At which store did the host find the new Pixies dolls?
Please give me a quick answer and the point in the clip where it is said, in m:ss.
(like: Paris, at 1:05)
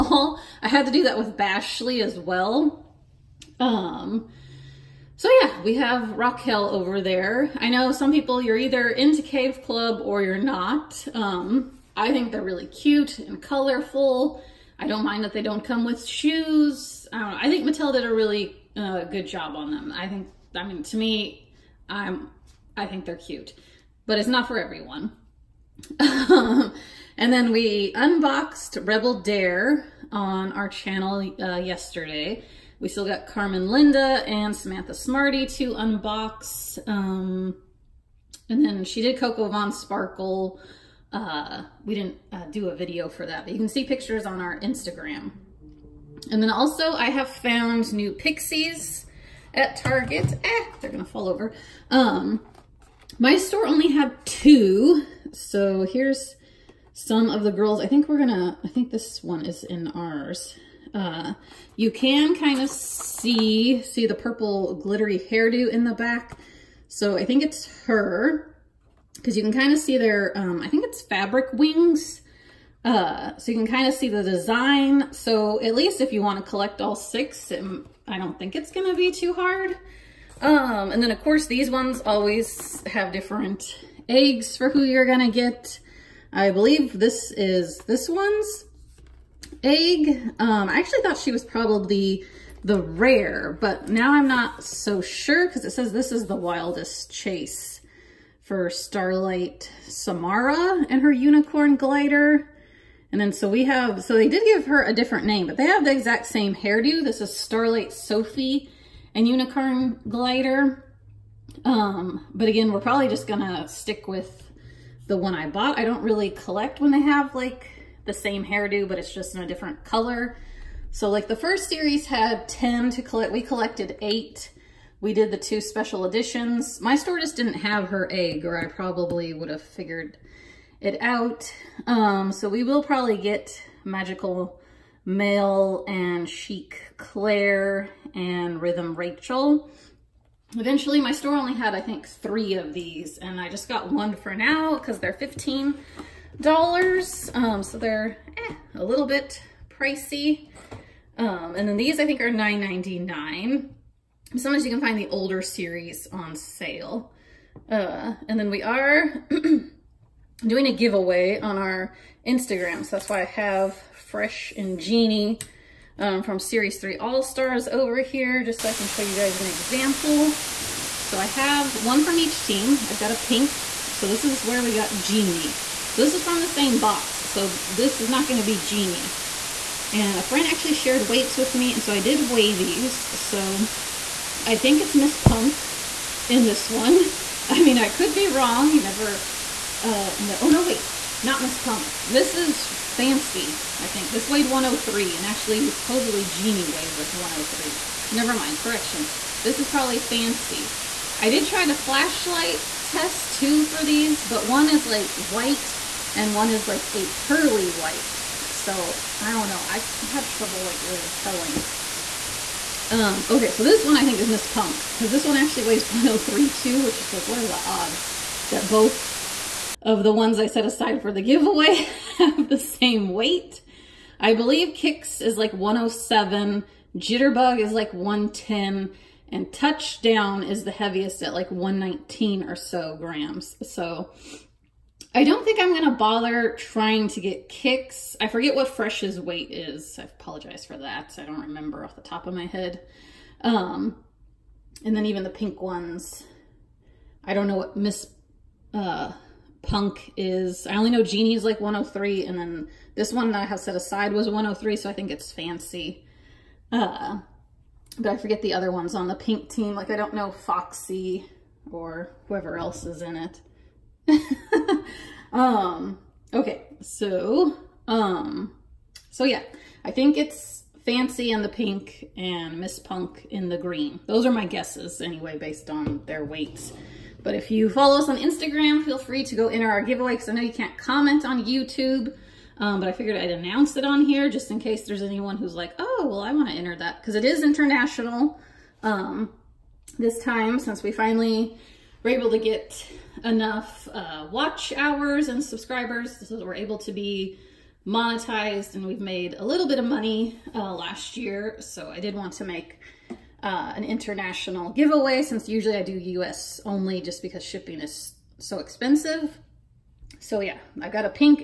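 Target, at 0:49.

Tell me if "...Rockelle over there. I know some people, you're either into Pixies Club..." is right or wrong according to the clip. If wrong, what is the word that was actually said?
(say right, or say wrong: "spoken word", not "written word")
wrong: "Cave", not "Pixies".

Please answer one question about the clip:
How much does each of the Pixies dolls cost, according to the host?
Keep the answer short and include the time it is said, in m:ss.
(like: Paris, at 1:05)
$15, at 2:25.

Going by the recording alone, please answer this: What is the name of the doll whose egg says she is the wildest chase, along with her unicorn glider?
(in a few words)
Starlight Samara.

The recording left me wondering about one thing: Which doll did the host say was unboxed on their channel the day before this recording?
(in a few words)
Rebel Dare.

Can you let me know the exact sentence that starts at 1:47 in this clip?
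This is Starlight Sophie and Unicorn Glider.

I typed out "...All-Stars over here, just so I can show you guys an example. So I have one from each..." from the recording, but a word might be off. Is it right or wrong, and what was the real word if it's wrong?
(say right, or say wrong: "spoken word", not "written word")
right.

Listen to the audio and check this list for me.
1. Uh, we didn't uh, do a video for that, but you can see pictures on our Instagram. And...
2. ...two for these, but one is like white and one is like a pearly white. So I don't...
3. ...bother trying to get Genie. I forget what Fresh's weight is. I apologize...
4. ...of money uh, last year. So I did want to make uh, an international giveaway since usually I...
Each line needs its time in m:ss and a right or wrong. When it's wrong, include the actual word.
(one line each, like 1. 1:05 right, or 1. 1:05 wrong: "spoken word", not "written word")
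1. 0:41 right
2. 3:23 right
3. 3:55 wrong: "Kicks", not "Genie"
4. 4:59 right.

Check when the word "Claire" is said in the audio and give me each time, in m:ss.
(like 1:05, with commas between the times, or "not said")
2:16.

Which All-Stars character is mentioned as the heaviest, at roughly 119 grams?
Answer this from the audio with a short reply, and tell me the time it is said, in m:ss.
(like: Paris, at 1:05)
Touchdown, at 3:49.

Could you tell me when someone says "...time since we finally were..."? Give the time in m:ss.
4:50.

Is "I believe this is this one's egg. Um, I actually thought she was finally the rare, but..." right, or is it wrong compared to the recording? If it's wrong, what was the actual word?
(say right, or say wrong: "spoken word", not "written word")
wrong: "probably", not "finally".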